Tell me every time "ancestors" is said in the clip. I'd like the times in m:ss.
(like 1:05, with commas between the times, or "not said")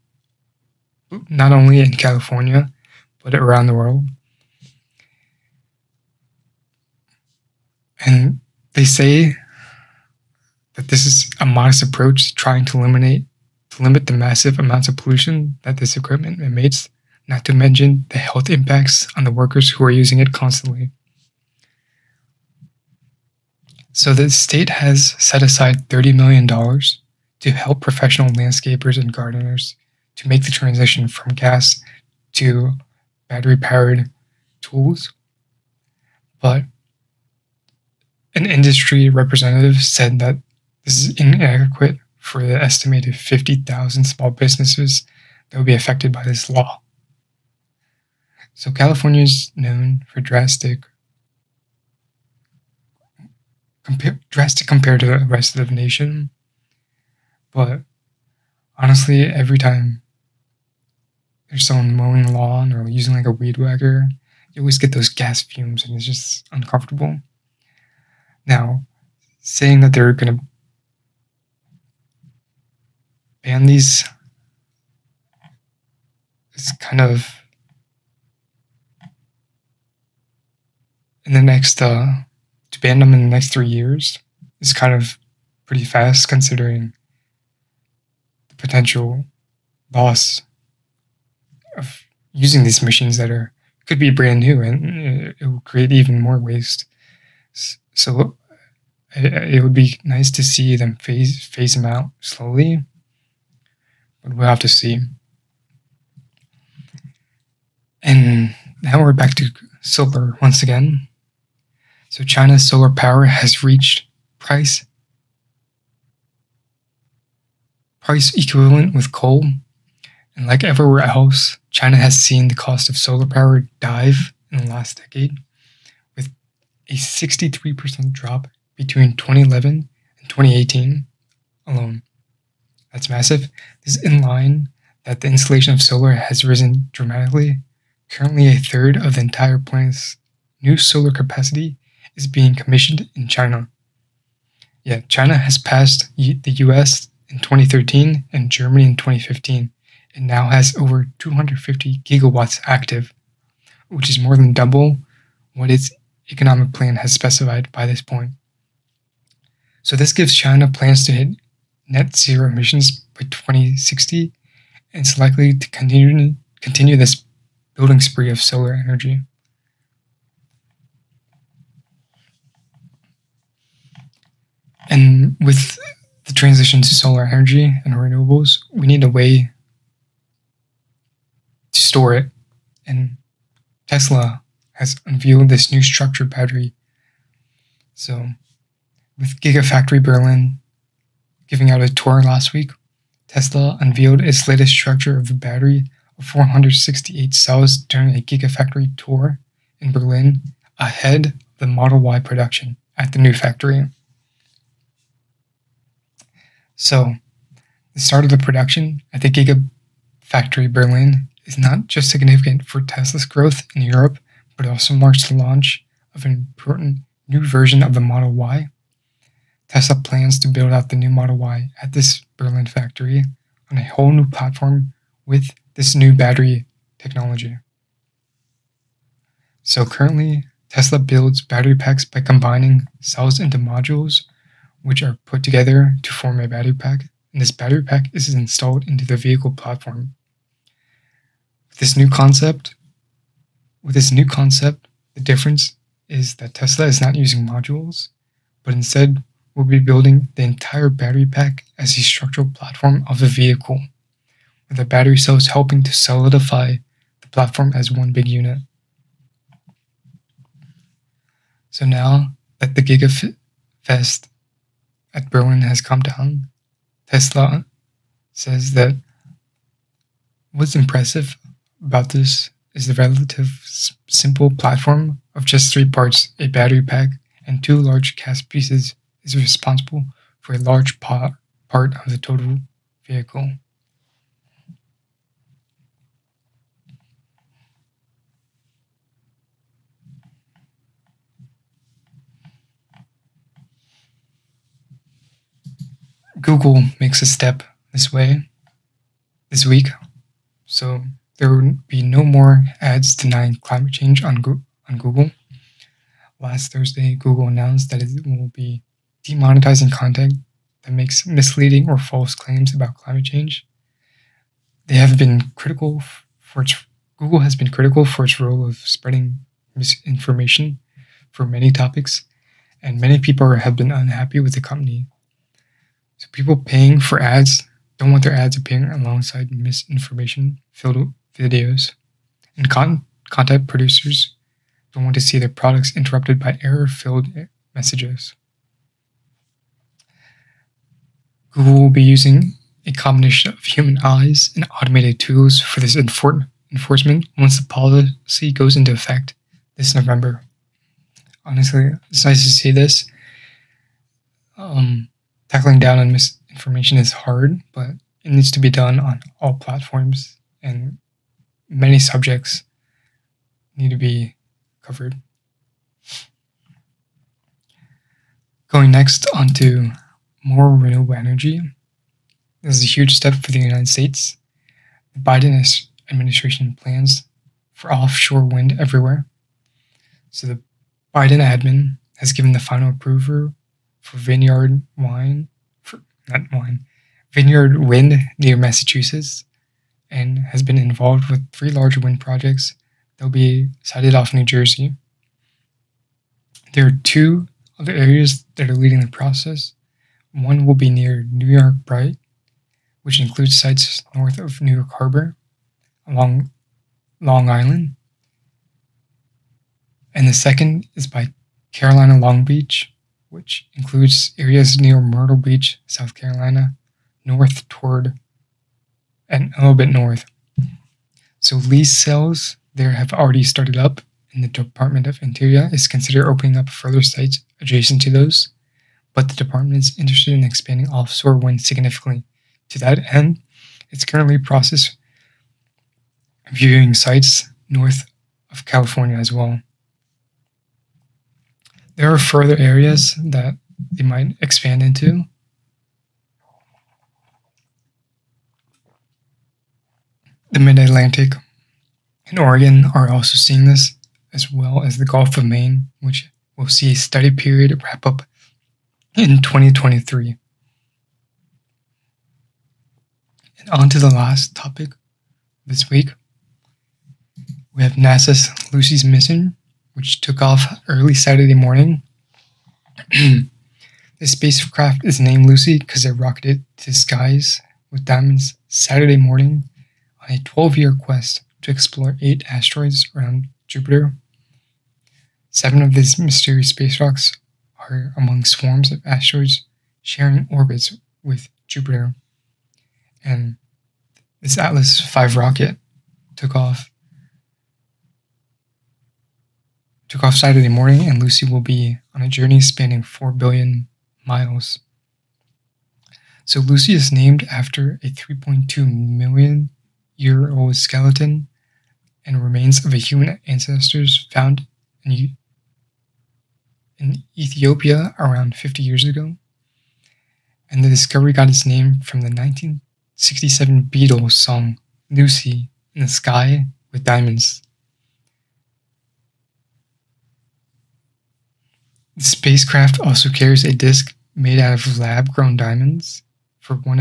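8:33.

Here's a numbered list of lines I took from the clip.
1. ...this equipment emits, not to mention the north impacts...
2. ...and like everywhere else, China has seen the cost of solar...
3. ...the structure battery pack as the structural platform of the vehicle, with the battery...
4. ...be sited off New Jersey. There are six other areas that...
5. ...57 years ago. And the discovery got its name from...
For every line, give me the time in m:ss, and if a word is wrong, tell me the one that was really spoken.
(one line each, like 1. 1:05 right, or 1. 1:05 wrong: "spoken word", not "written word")
1. 0:15 wrong: "health", not "north"
2. 2:00 right
3. 4:10 wrong: "entire", not "structure"
4. 6:33 wrong: "two", not "six"
5. 8:38 wrong: "50", not "57".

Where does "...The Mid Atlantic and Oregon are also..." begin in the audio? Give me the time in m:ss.
7:30.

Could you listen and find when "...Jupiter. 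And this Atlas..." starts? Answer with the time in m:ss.
8:11.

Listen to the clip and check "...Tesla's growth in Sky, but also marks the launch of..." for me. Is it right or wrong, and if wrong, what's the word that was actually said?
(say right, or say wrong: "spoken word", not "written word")
wrong: "Europe", not "Sky".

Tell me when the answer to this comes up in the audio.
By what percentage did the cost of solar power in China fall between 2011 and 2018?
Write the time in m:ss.
2:06.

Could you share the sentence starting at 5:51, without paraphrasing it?
Honestly, it's nice to see this.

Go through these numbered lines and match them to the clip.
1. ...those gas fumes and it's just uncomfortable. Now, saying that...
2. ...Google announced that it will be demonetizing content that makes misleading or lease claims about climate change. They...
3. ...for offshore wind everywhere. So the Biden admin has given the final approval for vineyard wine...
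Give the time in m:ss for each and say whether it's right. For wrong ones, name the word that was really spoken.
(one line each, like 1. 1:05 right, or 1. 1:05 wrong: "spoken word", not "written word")
1. 1:04 right
2. 5:07 wrong: "false", not "lease"
3. 6:17 right.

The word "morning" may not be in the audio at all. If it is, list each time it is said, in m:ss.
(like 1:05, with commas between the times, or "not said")
7:51, 7:59, 8:20.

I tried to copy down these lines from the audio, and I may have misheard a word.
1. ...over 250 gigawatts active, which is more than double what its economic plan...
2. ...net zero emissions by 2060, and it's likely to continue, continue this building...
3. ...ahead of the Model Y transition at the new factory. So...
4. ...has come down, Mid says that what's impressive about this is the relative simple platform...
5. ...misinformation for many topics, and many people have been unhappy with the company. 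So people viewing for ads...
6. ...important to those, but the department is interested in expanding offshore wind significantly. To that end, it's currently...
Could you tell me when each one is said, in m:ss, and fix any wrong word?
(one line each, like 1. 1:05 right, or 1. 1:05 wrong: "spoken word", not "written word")
1. 2:30 right
2. 2:41 right
3. 3:20 wrong: "production", not "transition"
4. 4:25 wrong: "Tesla", not "Mid"
5. 5:19 wrong: "paying", not "viewing"
6. 7:07 wrong: "adjacent", not "important".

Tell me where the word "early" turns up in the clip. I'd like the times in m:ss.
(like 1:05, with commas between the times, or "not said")
7:50.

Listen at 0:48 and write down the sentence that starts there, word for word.
So, California is known for drastic drastic compared to the rest of the nation.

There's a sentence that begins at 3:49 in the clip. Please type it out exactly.
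So currently, Tesla builds battery packs by combining cells into modules, which are put together to form a battery pack.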